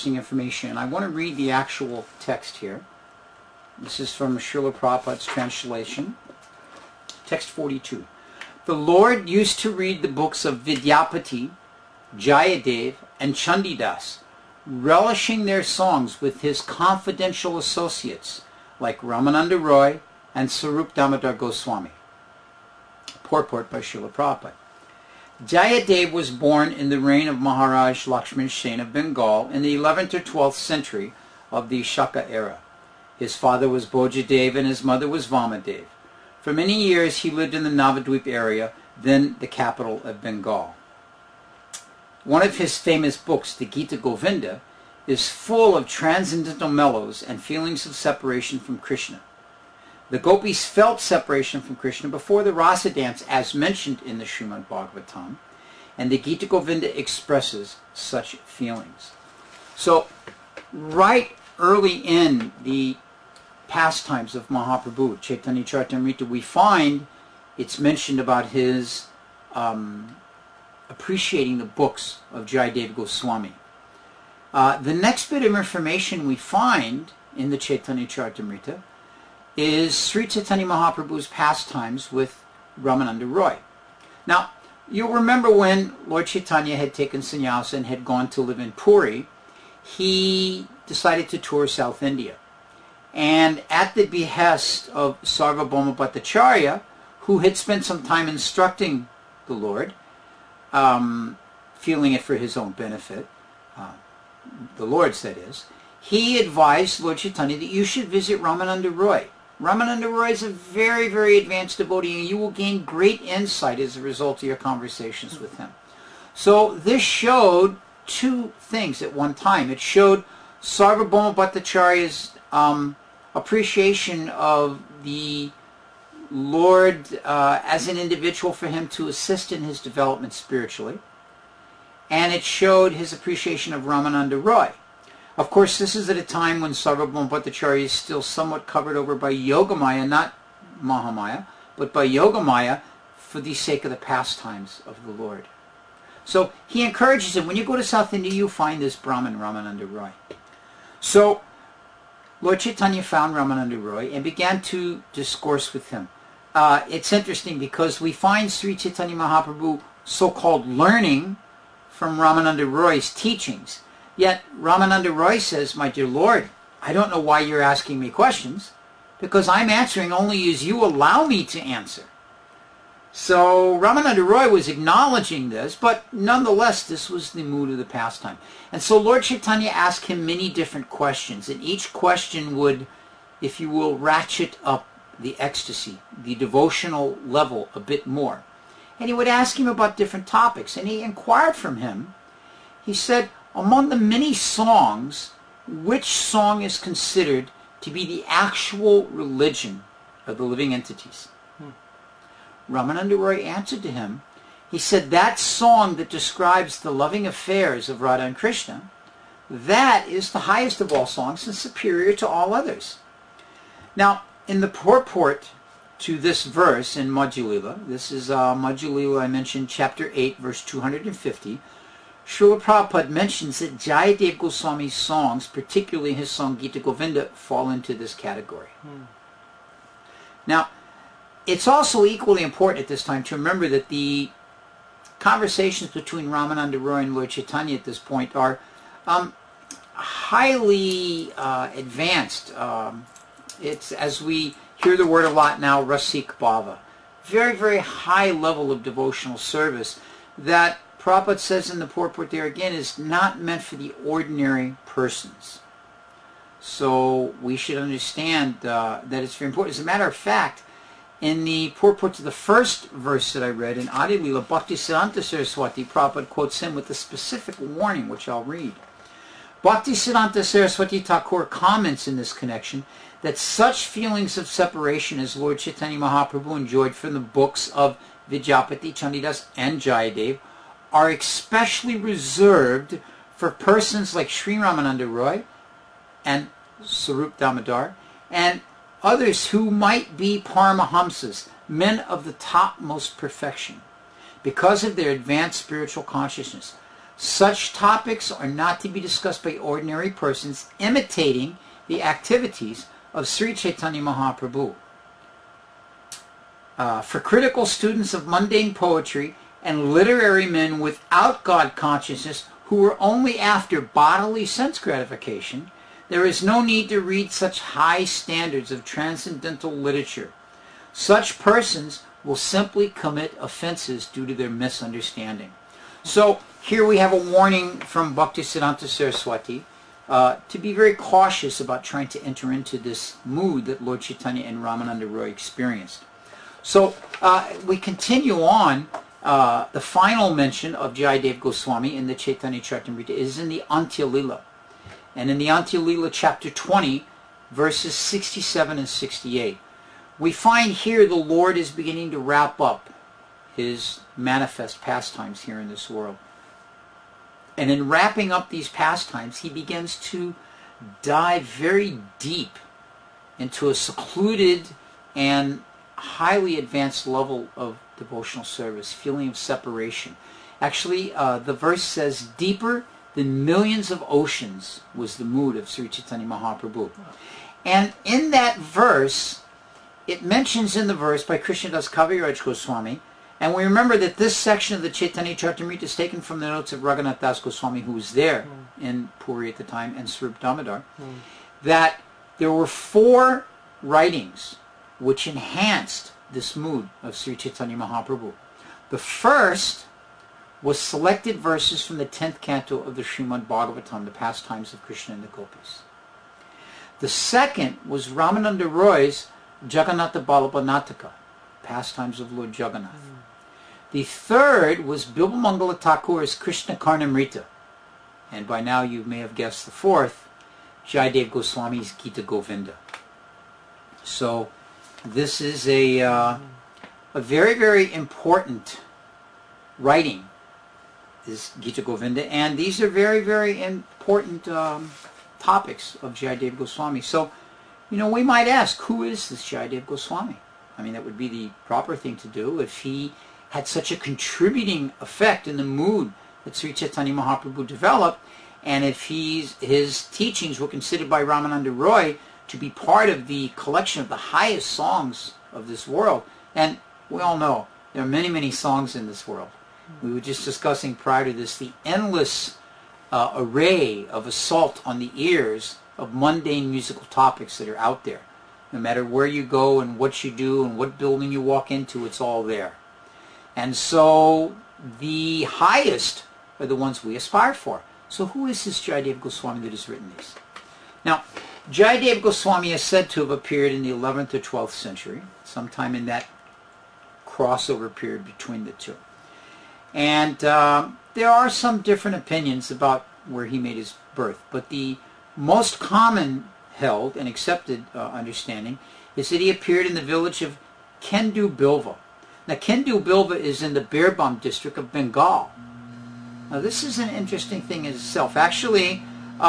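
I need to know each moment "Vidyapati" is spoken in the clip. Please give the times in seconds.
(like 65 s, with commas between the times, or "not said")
10 s, 278 s.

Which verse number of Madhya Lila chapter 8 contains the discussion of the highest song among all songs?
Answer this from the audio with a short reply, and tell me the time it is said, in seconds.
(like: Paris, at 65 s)
250, at 220 s.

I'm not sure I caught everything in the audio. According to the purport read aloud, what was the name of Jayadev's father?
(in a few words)
Bojadev.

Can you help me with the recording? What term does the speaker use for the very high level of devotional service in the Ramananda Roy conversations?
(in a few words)
Rasik Bhava.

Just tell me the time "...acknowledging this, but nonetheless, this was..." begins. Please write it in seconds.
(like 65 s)
174 s.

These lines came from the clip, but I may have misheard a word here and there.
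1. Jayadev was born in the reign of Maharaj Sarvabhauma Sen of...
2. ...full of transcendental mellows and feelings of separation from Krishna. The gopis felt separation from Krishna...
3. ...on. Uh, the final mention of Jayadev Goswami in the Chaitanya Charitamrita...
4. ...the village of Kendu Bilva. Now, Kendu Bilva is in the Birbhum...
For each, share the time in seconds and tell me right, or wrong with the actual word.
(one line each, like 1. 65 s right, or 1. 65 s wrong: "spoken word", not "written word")
1. 25 s wrong: "Lakshman", not "Sarvabhauma"
2. 45 s right
3. 338 s right
4. 499 s right.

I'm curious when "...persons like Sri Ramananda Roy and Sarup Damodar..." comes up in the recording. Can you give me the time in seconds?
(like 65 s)
283 s.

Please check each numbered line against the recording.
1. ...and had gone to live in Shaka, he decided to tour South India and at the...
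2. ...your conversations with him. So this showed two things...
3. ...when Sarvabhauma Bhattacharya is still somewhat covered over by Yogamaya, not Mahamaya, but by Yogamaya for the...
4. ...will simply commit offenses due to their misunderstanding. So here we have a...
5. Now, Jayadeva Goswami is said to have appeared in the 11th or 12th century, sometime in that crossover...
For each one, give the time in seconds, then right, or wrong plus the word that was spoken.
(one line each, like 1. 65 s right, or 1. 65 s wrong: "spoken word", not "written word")
1. 87 s wrong: "Puri", not "Shaka"
2. 114 s right
3. 136 s right
4. 322 s right
5. 481 s right.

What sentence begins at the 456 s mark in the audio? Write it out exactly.
And we all know there are many, many songs in this world.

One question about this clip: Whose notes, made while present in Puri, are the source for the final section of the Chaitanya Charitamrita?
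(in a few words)
Raghunath Das Goswami.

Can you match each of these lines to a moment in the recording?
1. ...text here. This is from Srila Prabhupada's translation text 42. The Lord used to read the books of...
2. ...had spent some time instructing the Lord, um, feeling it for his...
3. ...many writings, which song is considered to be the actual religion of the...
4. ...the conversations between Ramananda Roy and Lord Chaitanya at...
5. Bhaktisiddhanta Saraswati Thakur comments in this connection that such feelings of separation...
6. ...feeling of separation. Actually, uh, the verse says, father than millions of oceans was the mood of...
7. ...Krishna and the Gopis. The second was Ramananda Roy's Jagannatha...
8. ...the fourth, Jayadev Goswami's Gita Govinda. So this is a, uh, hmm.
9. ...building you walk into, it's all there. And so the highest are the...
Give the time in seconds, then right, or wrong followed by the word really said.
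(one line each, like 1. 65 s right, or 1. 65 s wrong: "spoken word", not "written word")
1. 2 s right
2. 97 s right
3. 193 s wrong: "songs", not "writings"
4. 233 s right
5. 269 s right
6. 368 s wrong: "deeper", not "father"
7. 404 s right
8. 419 s right
9. 470 s right.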